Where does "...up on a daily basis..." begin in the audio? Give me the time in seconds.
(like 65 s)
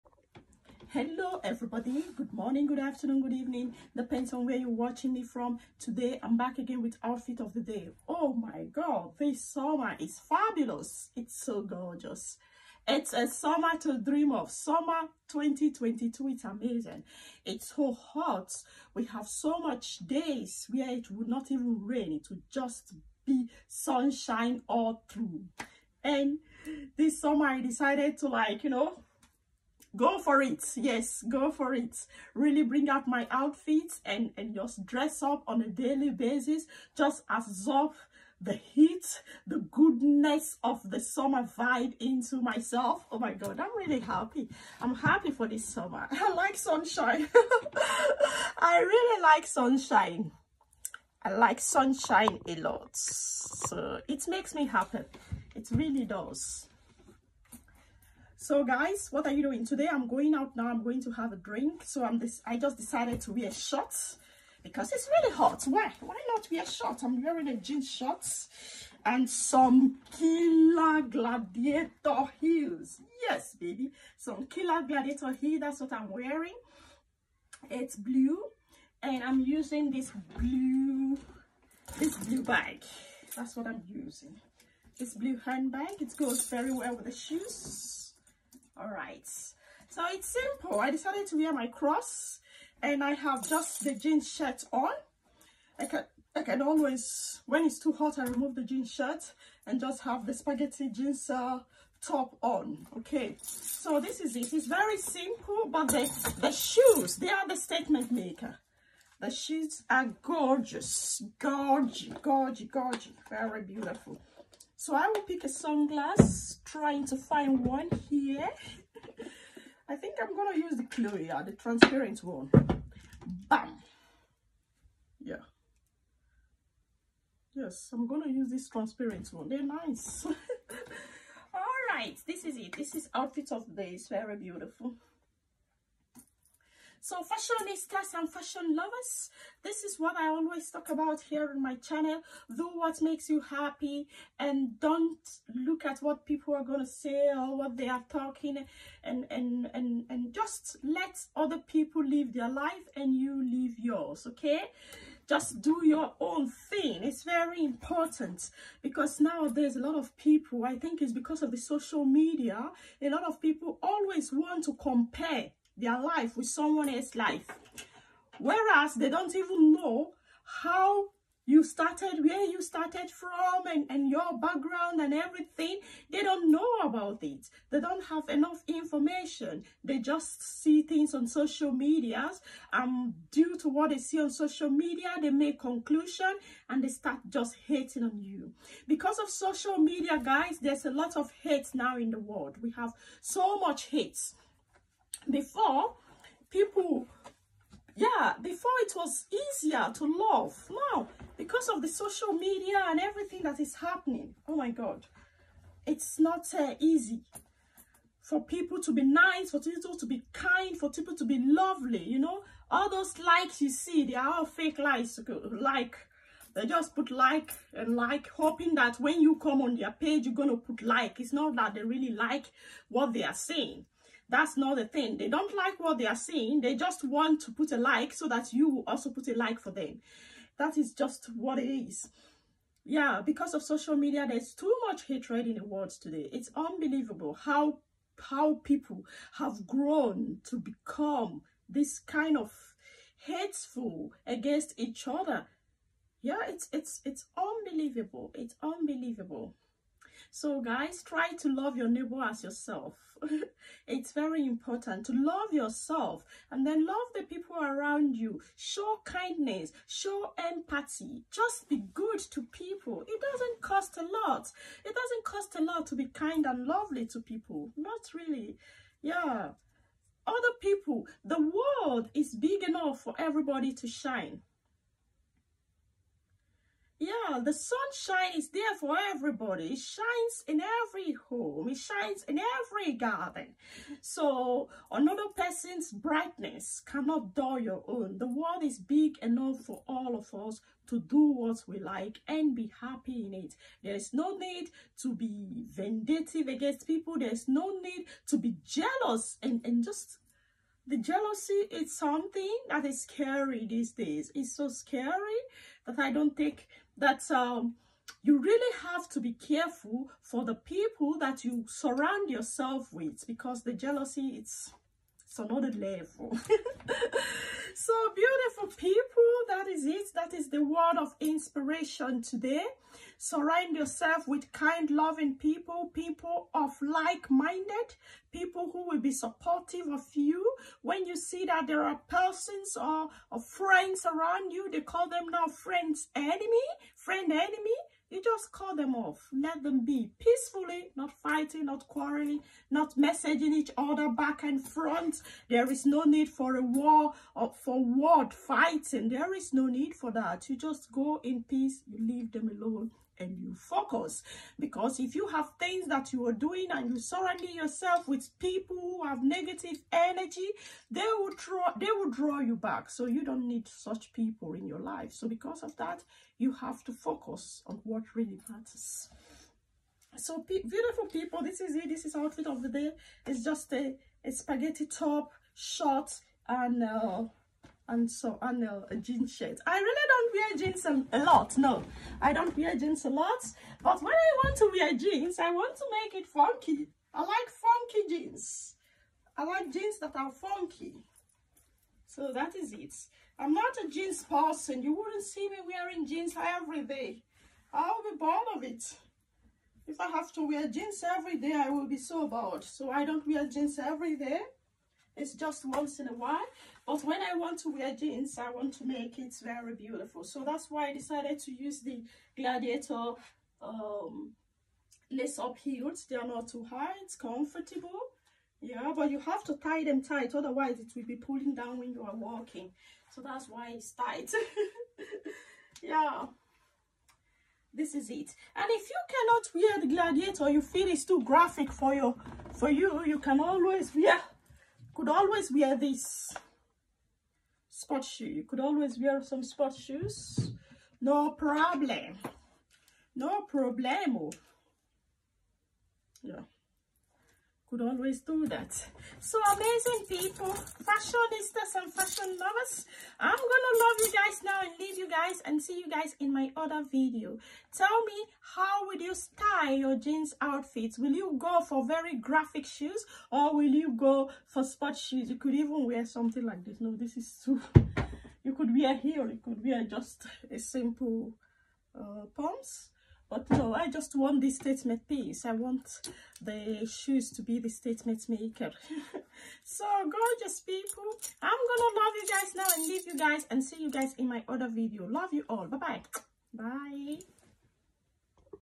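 35 s.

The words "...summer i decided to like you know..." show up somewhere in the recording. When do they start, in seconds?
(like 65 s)
27 s.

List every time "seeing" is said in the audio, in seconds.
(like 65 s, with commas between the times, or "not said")
226 s.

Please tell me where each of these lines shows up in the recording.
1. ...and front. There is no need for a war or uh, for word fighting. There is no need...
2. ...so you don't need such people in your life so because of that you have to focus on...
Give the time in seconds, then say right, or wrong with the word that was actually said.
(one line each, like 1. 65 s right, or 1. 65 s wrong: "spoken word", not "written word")
1. 344 s right
2. 362 s right.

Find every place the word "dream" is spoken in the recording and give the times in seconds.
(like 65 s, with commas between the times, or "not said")
13 s.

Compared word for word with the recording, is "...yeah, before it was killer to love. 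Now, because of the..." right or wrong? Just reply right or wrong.
wrong.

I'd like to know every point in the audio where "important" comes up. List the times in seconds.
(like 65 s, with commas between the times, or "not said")
157 s, 254 s.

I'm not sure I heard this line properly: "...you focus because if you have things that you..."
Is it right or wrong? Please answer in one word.
right.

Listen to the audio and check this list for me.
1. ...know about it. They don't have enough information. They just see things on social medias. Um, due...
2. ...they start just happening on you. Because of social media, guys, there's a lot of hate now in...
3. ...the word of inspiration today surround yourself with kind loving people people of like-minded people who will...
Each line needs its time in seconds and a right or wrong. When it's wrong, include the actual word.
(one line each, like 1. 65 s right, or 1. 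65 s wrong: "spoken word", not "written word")
1. 176 s right
2. 186 s wrong: "hating", not "happening"
3. 320 s right.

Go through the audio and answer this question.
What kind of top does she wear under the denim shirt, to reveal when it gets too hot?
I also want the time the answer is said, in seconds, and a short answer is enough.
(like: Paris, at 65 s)
Spaghetti top, at 374 s.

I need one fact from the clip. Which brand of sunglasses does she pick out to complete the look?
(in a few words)
Chloe.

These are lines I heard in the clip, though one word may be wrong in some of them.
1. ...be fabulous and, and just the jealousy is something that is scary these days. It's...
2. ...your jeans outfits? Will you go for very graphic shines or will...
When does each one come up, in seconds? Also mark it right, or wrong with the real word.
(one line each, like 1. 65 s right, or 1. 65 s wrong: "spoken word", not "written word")
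1. 298 s wrong: "jealous", not "fabulous"
2. 459 s wrong: "shoes", not "shines".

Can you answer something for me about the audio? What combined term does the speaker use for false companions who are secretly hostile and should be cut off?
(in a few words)
Friend enemy.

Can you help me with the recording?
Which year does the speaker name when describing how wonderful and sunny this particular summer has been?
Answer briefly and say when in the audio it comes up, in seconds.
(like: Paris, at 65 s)
2022, at 14 s.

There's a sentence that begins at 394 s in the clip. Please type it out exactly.
You wouldn't see me wearing jeans every day.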